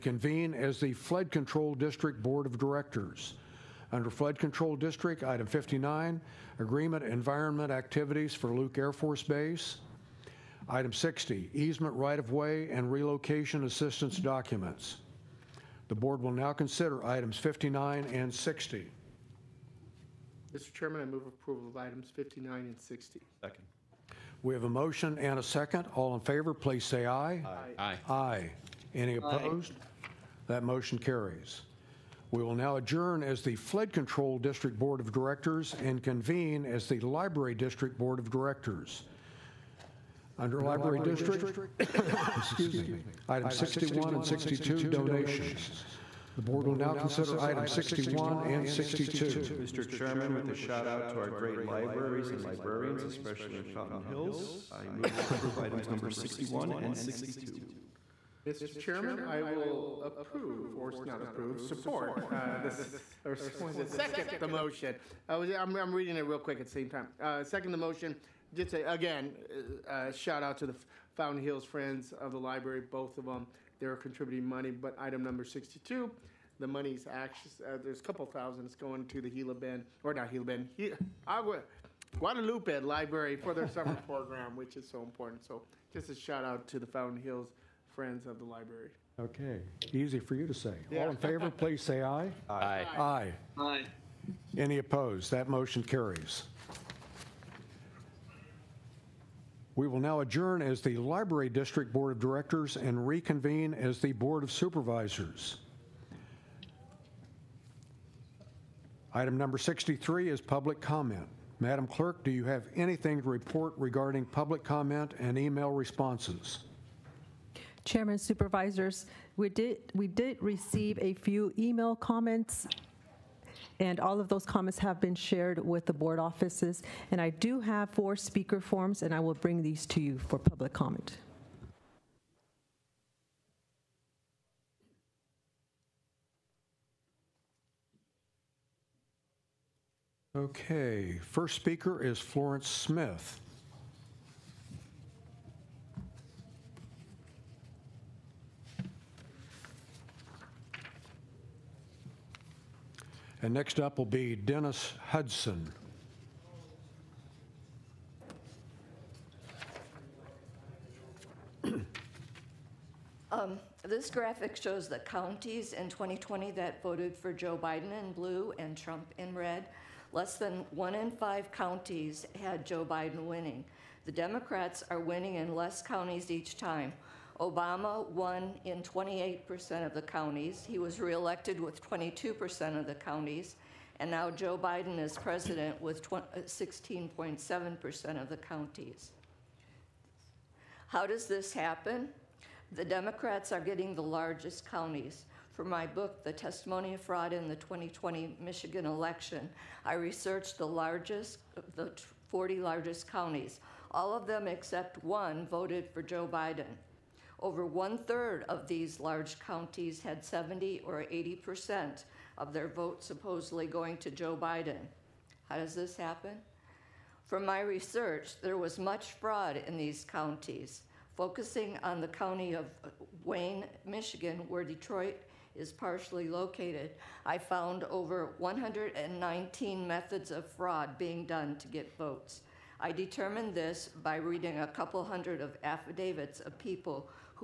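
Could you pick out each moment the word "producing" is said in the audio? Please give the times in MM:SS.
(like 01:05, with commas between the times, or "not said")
not said.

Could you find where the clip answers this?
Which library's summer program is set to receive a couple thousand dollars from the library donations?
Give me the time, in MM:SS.
01:22.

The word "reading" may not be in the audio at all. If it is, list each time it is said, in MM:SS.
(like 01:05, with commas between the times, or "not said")
01:05, 03:54.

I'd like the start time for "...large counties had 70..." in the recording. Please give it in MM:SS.
03:28.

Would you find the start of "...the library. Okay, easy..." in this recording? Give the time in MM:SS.
01:28.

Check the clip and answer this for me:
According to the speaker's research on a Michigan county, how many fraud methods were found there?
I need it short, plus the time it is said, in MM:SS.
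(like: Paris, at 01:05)
over 119, at 03:47.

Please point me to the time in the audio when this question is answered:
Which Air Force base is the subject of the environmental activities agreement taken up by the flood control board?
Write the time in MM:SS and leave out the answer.
00:08.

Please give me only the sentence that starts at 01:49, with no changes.
Item number 63 is public comment.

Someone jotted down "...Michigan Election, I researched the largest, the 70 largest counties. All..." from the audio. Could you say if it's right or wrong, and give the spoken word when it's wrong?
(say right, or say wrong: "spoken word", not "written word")
wrong: "40", not "70".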